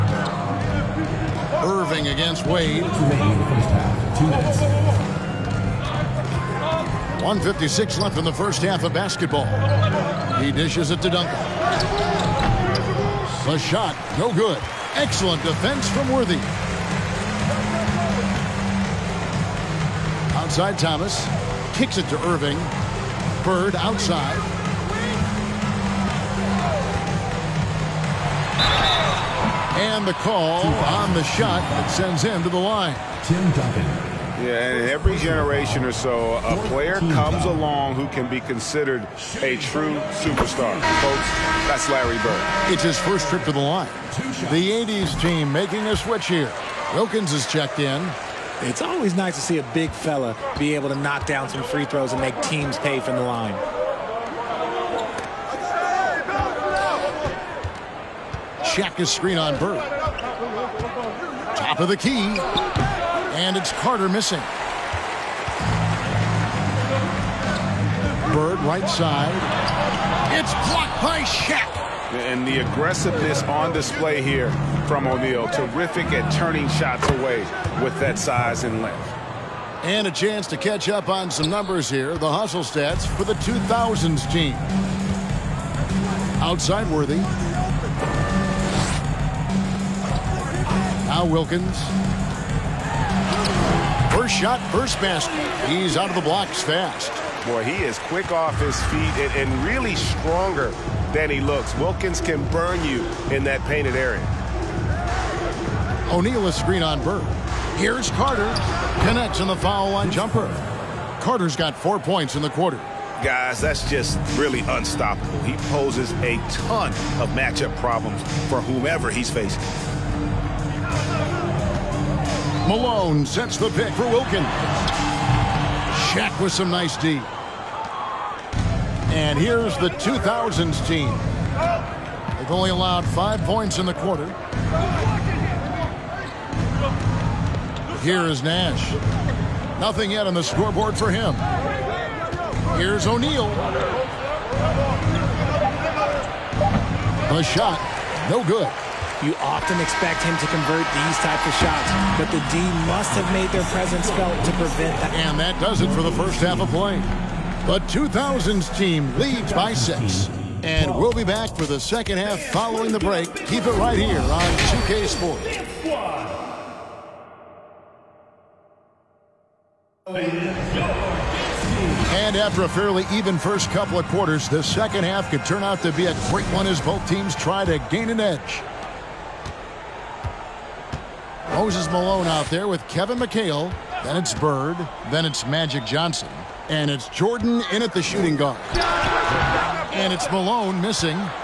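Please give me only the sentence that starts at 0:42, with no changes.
It's his first trip to the line.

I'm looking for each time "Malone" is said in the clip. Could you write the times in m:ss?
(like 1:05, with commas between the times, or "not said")
2:02, 3:01, 3:10.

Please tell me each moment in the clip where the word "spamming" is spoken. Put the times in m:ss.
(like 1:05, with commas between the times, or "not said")
not said.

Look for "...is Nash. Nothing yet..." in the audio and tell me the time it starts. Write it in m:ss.
2:18.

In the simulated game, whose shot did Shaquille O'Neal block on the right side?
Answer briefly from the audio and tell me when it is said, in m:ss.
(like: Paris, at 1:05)
Larry Bird, at 1:08.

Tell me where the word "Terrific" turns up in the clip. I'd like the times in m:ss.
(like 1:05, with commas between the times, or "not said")
1:15.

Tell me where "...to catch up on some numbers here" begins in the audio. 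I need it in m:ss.
1:20.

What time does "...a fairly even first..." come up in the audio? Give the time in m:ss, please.
2:52.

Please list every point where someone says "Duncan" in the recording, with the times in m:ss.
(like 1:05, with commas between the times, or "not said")
0:11, 0:33.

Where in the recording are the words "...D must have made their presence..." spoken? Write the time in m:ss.
2:32.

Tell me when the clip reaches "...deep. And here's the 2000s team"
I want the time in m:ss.
2:06.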